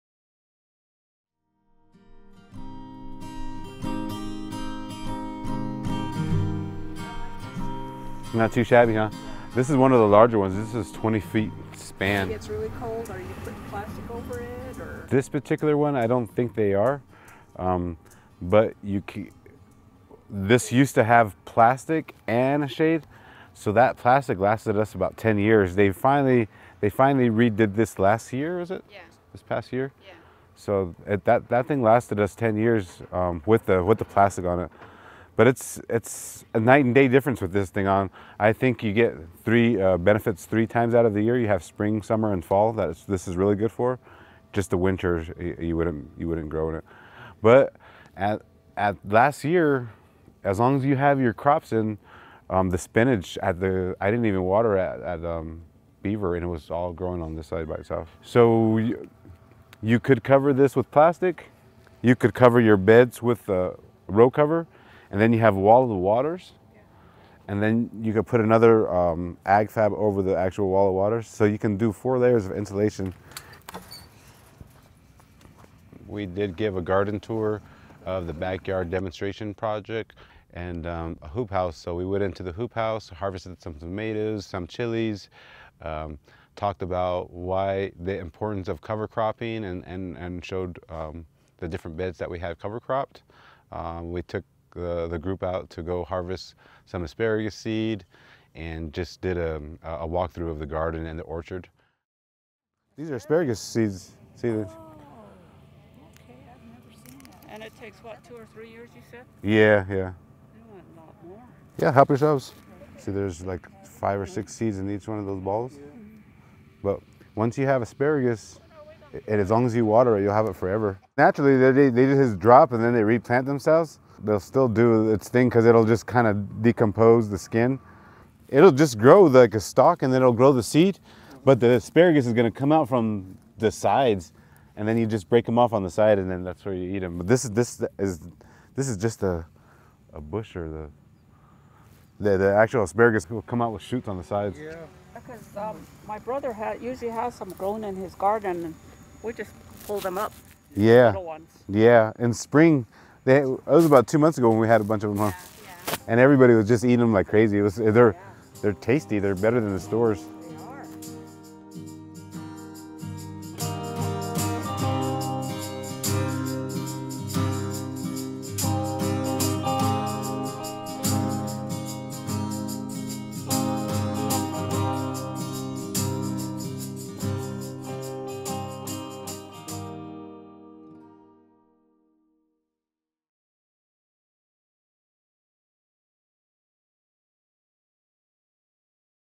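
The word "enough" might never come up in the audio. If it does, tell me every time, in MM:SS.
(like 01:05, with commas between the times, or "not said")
not said.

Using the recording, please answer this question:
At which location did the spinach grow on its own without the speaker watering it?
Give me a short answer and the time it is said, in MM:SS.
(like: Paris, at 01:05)
Beaver, at 00:56.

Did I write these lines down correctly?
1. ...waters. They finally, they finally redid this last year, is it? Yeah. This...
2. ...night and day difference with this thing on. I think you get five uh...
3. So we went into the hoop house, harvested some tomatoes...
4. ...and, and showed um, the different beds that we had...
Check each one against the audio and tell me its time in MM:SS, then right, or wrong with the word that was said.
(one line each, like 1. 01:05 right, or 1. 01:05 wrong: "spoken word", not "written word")
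1. 00:25 wrong: "years", not "waters"
2. 00:36 wrong: "three", not "five"
3. 01:21 right
4. 01:29 right.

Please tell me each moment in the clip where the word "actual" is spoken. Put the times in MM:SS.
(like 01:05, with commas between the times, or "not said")
01:10, 02:22.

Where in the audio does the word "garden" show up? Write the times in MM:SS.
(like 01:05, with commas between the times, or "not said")
01:16, 01:40, 02:28.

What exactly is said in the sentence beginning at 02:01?
Naturally, they, they just drop and then they replant themselves.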